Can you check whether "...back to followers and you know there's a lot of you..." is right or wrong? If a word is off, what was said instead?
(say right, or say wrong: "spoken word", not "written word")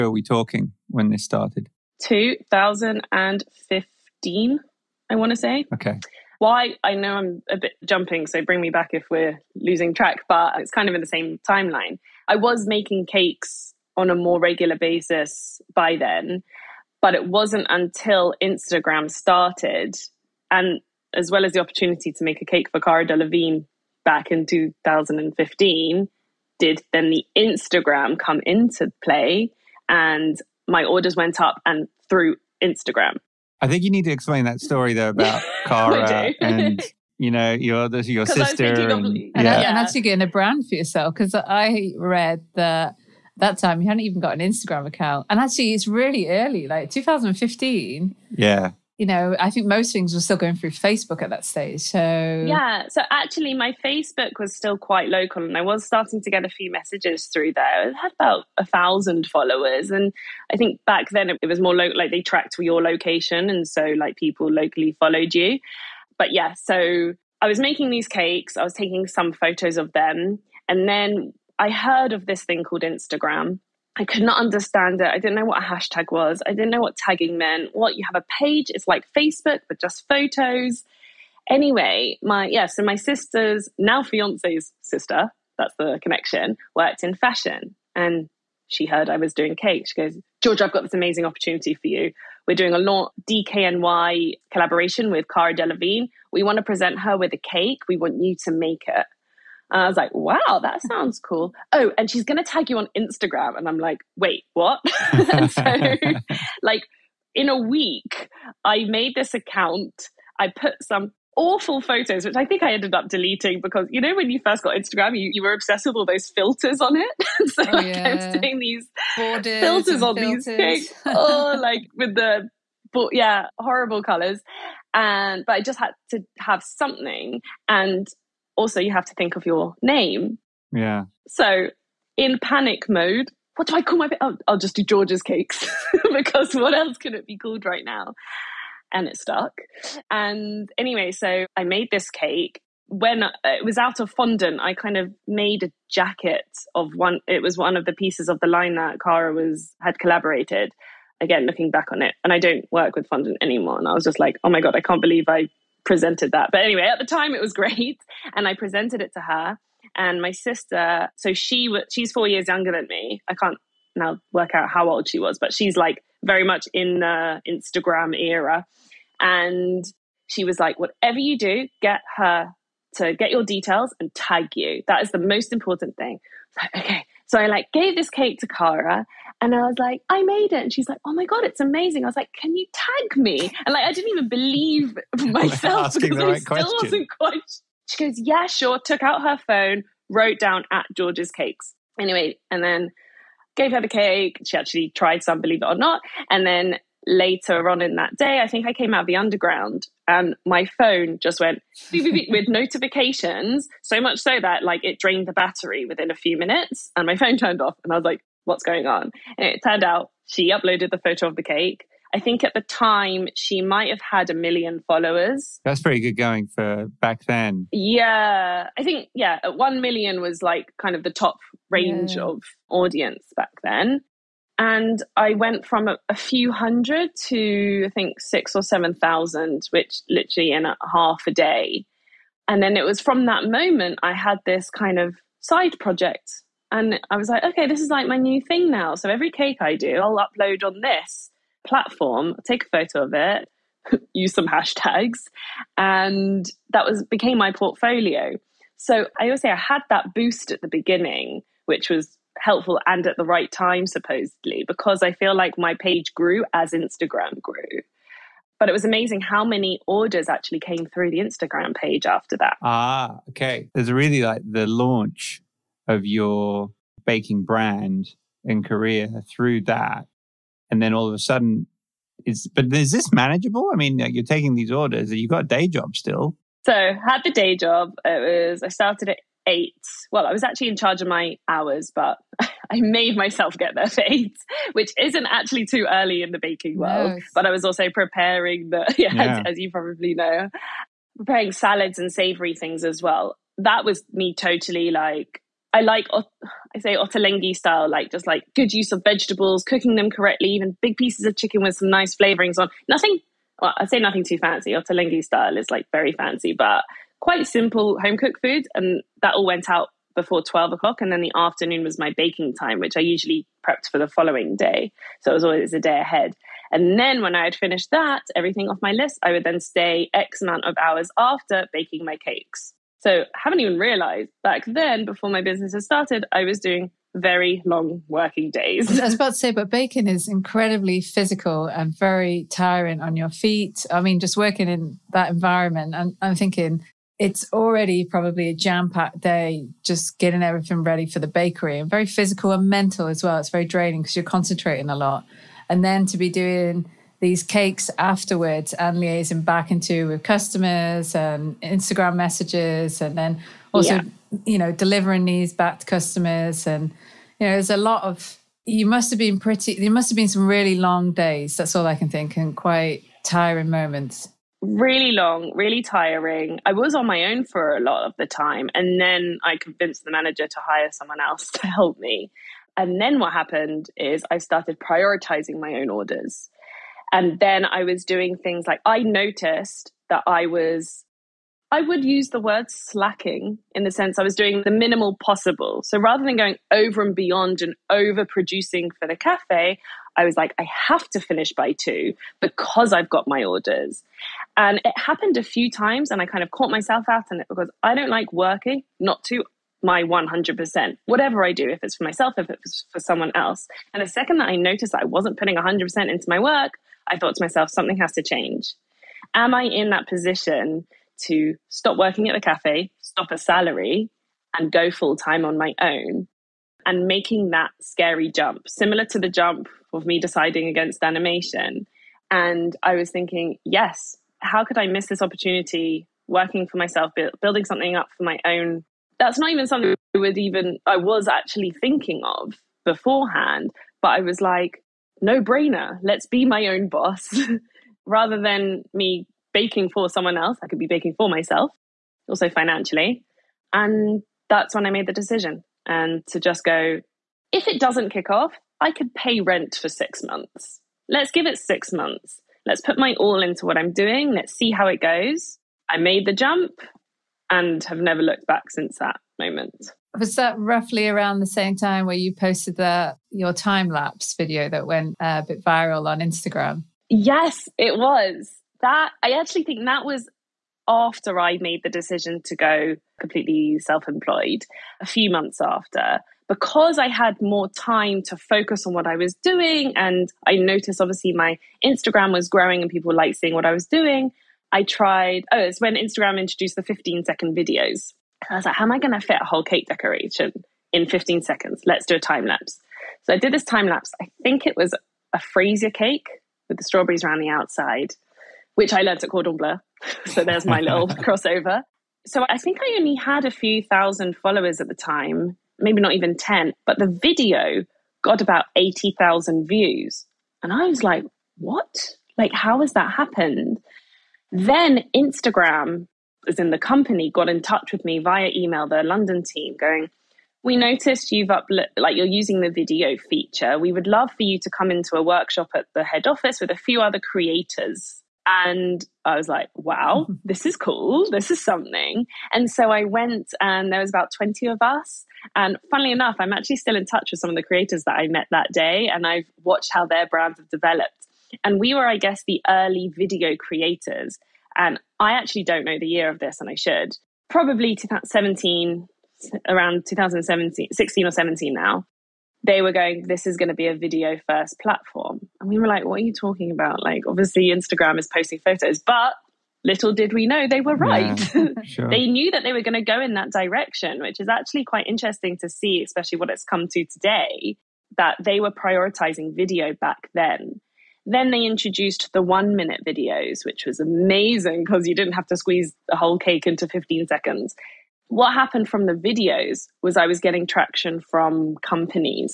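wrong: "customers", not "followers".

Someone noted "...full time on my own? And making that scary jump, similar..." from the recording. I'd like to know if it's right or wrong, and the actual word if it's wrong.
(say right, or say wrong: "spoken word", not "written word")
right.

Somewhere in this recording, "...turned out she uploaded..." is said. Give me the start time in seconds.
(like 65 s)
209 s.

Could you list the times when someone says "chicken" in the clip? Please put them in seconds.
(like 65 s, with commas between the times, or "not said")
301 s.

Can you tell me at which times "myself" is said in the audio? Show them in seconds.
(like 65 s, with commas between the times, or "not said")
185 s, 283 s, 396 s, 402 s, 407 s, 426 s, 441 s.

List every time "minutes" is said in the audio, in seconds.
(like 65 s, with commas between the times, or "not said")
206 s, 572 s.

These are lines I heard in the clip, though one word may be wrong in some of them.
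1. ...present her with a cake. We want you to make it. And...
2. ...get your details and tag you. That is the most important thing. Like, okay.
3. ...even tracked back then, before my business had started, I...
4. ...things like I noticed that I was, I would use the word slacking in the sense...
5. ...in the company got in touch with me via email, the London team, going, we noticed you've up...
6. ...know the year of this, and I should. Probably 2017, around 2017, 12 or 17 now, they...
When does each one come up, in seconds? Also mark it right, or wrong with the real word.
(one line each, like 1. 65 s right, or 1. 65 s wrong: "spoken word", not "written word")
1. 96 s right
2. 173 s right
3. 323 s wrong: "realized", not "tracked"
4. 378 s right
5. 516 s right
6. 545 s wrong: "16", not "12".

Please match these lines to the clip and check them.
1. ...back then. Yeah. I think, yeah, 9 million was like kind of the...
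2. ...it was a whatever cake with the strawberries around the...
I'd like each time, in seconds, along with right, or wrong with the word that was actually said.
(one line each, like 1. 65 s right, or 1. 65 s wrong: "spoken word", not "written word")
1. 217 s wrong: "1", not "9"
2. 494 s wrong: "freezer", not "whatever".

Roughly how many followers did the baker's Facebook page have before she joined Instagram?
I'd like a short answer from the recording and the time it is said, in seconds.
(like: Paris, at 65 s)
1,000, at 58 s.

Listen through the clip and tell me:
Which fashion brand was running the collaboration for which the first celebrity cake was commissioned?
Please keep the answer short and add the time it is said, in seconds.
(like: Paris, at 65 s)
DKNY, at 93 s.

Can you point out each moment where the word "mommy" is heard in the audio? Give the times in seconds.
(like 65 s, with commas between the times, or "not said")
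not said.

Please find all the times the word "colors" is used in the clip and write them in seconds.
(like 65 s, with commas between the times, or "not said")
124 s.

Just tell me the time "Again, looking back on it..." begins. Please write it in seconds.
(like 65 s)
151 s.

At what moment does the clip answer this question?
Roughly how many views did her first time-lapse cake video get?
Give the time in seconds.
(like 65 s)
508 s.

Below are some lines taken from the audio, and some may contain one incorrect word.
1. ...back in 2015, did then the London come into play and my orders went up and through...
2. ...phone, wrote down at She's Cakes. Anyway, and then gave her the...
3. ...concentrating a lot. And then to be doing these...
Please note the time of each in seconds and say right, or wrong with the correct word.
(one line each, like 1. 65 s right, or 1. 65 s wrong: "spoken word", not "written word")
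1. 24 s wrong: "Instagram", not "London"
2. 189 s wrong: "Georgia", not "She"
3. 344 s right.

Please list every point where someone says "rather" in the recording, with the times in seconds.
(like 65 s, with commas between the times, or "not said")
385 s, 438 s.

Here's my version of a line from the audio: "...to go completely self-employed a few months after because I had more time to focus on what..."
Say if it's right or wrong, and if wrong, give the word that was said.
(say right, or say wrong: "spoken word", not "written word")
right.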